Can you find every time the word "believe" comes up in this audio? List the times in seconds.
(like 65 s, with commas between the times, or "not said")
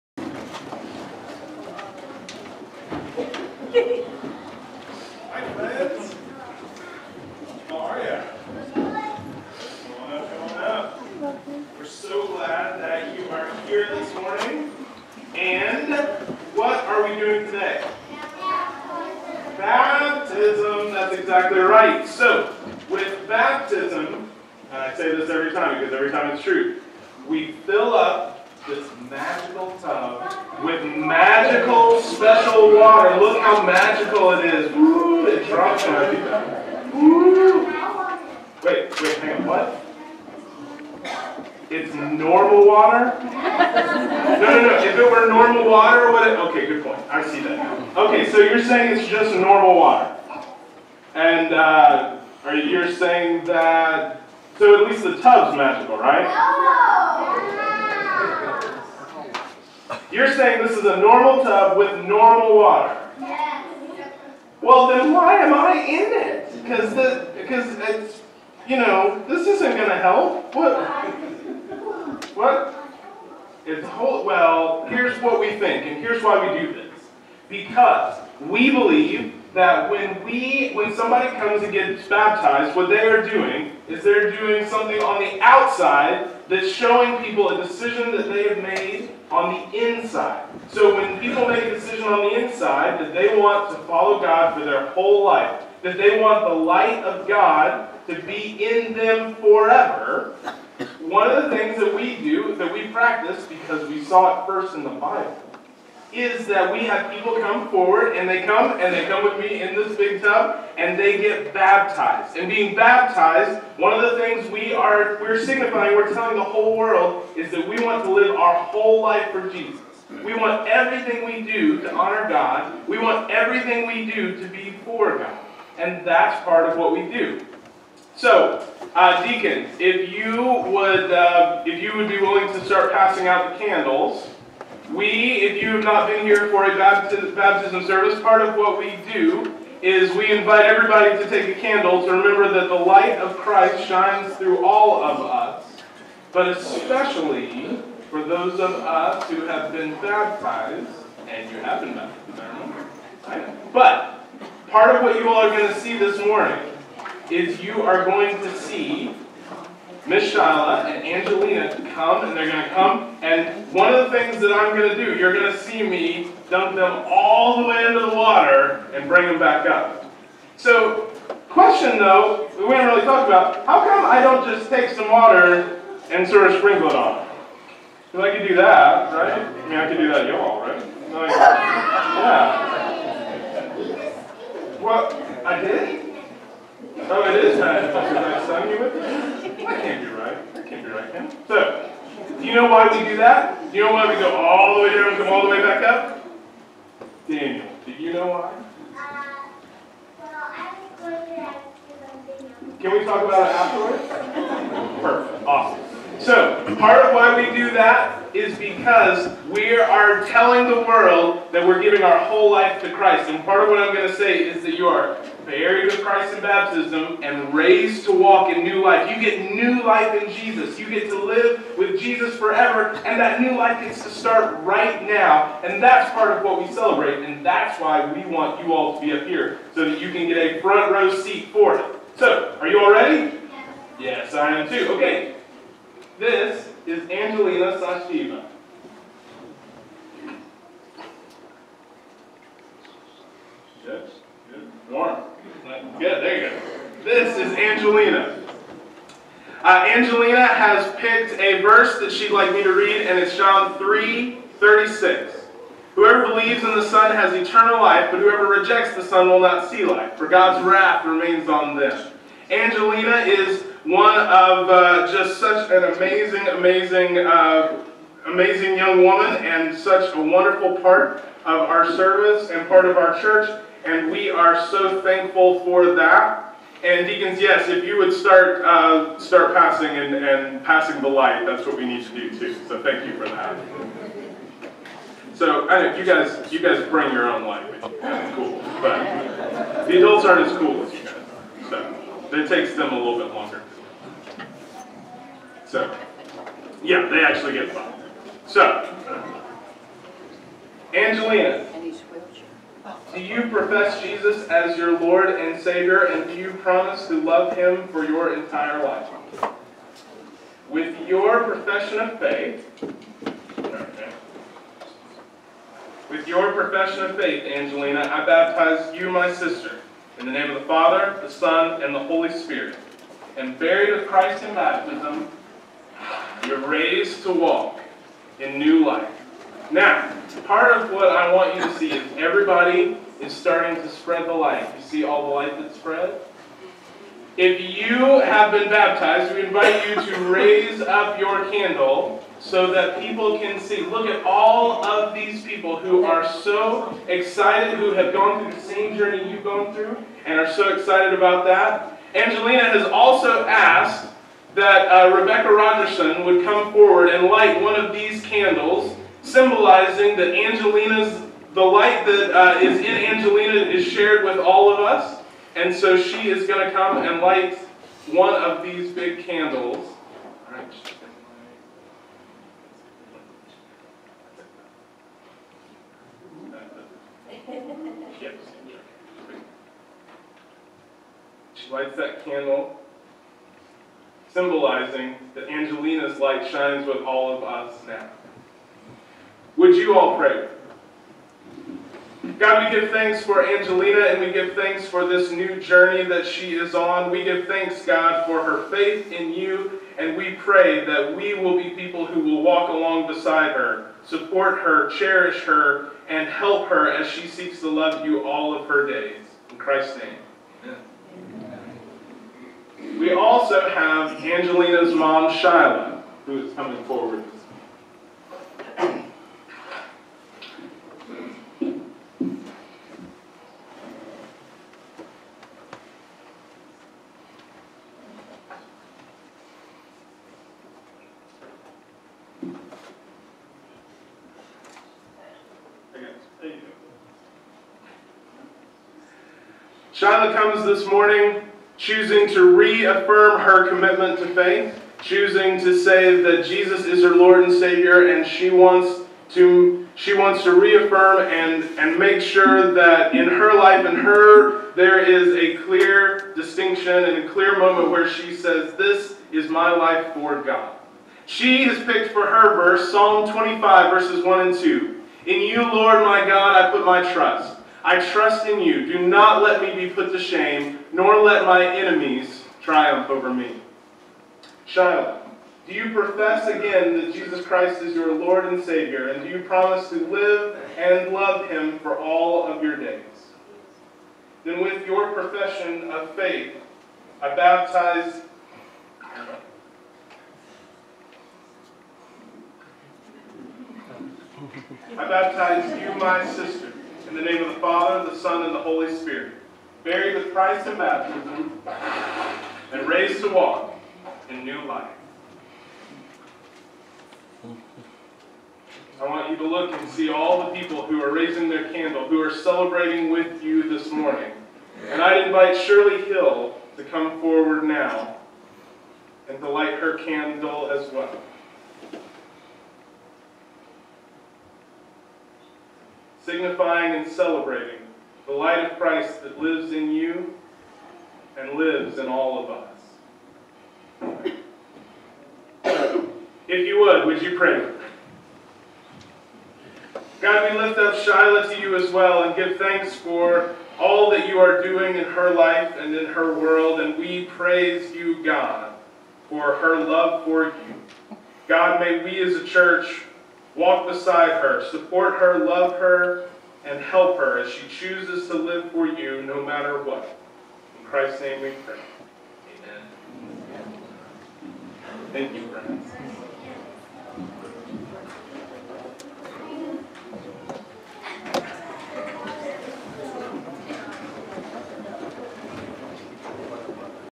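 78 s, 256 s.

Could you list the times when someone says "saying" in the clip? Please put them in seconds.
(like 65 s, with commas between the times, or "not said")
48 s, 52 s, 60 s.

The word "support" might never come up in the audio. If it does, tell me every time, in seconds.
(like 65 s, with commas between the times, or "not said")
404 s, 554 s.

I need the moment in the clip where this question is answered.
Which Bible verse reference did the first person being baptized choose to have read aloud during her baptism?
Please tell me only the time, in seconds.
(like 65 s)
253 s.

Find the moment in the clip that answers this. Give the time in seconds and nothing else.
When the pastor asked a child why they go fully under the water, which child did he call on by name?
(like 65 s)
197 s.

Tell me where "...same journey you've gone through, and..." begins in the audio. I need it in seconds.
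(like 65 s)
348 s.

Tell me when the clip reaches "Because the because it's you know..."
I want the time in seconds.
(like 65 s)
66 s.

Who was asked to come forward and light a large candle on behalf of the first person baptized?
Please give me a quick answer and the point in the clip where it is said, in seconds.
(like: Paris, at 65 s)
Rebecca Rogerson, at 355 s.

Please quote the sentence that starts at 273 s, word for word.
And we are so thankful for that.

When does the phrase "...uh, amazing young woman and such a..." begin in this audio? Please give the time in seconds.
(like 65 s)
267 s.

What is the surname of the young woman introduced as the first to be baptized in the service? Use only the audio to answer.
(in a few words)
Sachdeva.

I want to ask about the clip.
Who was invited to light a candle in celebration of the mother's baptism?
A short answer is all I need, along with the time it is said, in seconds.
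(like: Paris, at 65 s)
Shirley Hill, at 515 s.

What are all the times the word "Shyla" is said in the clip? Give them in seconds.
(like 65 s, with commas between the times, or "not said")
160 s, 415 s, 439 s, 474 s, 540 s.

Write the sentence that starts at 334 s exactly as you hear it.
You see all the light that's spread?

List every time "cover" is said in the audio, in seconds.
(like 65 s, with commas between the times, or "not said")
not said.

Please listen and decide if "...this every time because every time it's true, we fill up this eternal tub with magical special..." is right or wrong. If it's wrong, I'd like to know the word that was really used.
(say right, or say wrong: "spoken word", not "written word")
wrong: "magical", not "eternal".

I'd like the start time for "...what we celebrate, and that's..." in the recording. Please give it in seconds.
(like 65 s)
226 s.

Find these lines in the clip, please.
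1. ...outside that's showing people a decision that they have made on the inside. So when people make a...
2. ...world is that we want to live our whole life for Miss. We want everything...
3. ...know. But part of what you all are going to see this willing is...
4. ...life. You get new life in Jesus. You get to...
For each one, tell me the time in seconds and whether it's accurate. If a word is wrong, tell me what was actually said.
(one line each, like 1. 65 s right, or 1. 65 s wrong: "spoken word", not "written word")
1. 85 s right
2. 116 s wrong: "Jesus", not "Miss"
3. 153 s wrong: "morning", not "willing"
4. 218 s right.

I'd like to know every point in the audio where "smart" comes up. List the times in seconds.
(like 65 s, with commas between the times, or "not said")
not said.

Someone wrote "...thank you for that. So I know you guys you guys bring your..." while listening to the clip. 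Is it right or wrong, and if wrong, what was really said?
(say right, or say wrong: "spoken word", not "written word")
right.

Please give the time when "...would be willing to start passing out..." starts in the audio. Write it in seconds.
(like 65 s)
131 s.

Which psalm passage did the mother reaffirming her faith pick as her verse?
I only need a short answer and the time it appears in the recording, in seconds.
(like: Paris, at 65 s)
Psalm 25:1-2, at 462 s.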